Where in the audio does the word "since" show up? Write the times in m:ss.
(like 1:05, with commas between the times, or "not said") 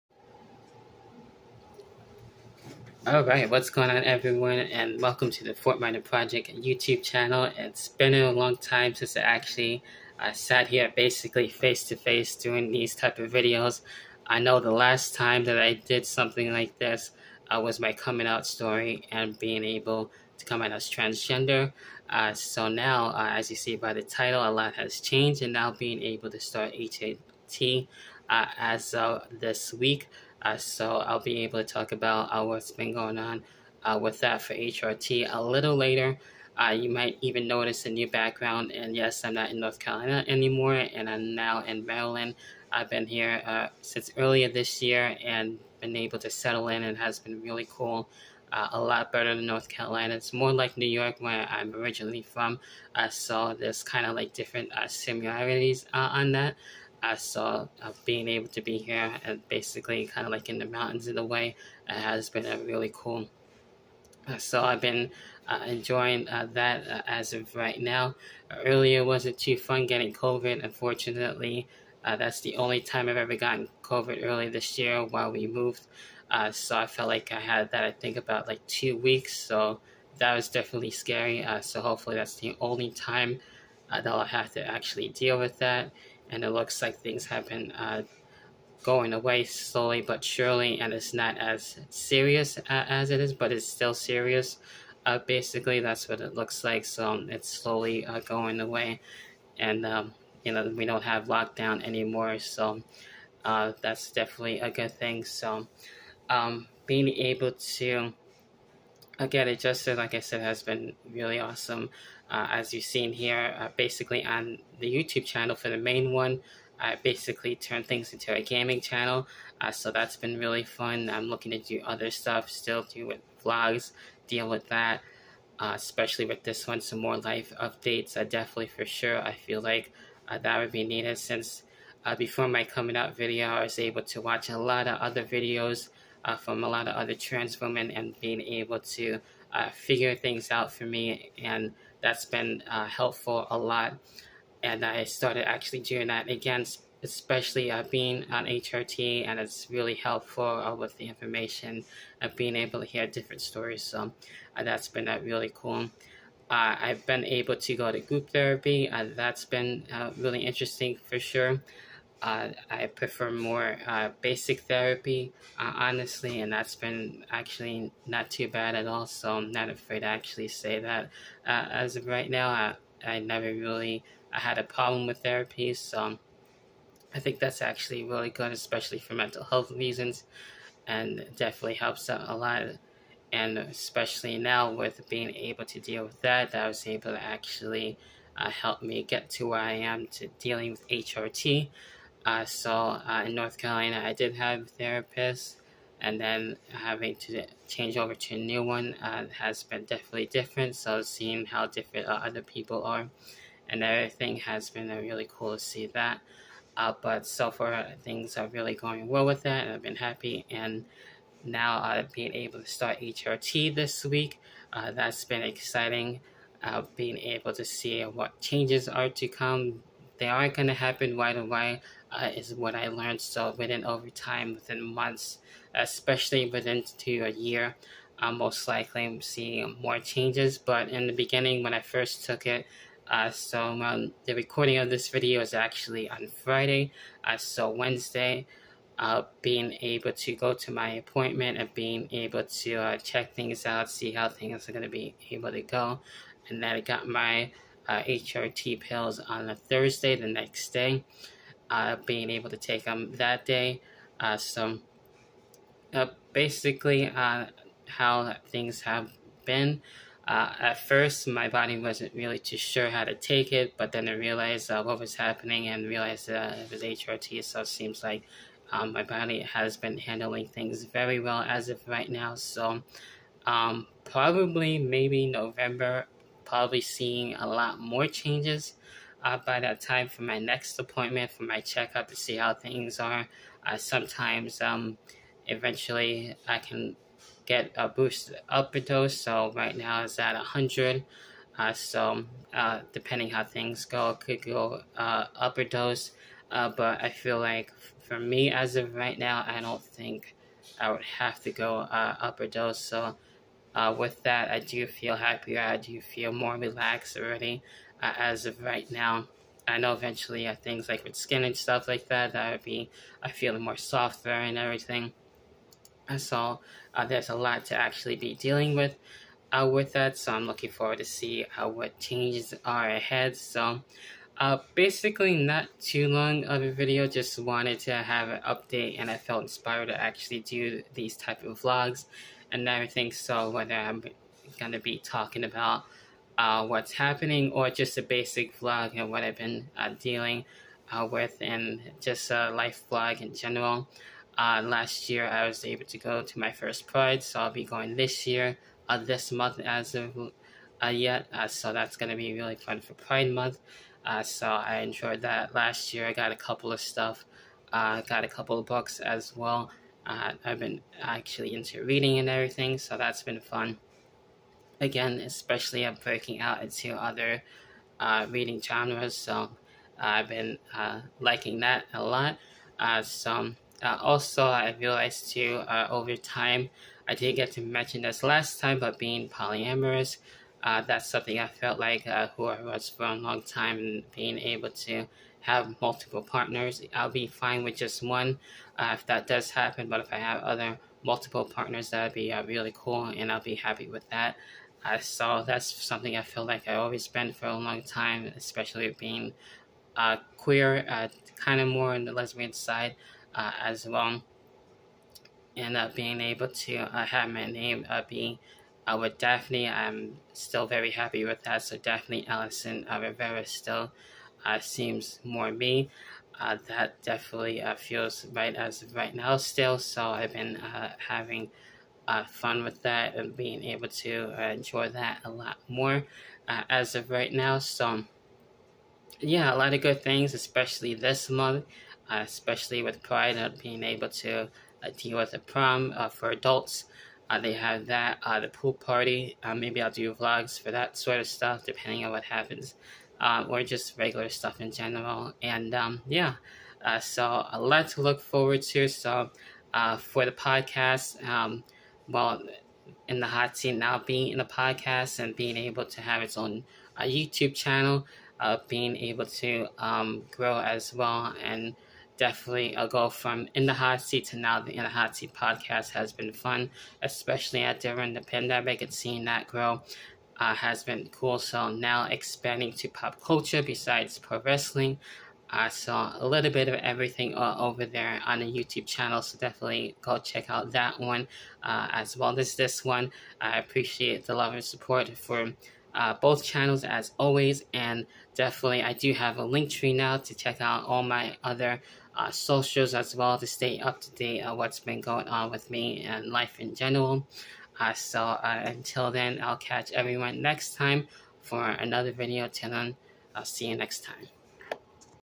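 0:08, 0:43, 2:11.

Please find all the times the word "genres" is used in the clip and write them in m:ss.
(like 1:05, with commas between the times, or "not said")
6:08.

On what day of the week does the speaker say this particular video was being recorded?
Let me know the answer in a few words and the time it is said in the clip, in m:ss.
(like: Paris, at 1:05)
Friday, at 3:56.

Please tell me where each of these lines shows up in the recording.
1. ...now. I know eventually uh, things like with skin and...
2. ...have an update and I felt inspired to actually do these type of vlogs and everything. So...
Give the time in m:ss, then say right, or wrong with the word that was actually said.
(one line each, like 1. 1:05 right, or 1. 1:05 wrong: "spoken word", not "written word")
1. 5:08 right
2. 5:27 right.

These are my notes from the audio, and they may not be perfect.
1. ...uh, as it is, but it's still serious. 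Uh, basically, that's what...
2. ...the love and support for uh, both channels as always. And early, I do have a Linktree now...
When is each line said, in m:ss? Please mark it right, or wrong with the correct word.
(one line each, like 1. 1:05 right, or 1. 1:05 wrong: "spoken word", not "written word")
1. 1:32 right
2. 8:04 wrong: "definitely", not "early".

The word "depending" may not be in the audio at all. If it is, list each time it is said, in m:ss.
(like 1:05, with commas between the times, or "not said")
4:52, 7:21.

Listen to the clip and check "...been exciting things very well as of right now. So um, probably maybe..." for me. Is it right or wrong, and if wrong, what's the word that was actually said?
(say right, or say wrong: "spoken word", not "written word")
wrong: "handling", not "exciting".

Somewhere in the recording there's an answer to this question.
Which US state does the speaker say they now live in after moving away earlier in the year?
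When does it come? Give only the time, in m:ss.
0:41.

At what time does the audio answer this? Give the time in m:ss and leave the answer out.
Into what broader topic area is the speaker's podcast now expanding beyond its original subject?
7:52.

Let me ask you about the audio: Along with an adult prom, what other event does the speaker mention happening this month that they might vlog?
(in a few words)
Pool party.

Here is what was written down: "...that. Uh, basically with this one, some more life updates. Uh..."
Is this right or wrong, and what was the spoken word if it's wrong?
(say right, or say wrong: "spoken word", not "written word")
wrong: "especially", not "basically".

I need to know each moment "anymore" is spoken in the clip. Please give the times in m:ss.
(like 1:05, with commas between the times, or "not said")
0:40, 1:41.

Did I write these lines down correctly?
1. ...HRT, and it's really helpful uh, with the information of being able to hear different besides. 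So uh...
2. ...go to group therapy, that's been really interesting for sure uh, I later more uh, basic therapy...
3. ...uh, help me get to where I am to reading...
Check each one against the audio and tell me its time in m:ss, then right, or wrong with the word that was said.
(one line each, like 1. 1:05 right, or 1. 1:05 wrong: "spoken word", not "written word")
1. 2:28 wrong: "stories", not "besides"
2. 2:37 wrong: "prefer", not "later"
3. 3:08 wrong: "dealing", not "reading".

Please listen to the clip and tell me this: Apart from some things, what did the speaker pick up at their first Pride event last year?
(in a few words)
Books.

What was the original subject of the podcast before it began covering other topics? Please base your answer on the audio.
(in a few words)
Pro wrestling.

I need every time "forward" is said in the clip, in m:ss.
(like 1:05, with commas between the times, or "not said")
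5:20, 7:28.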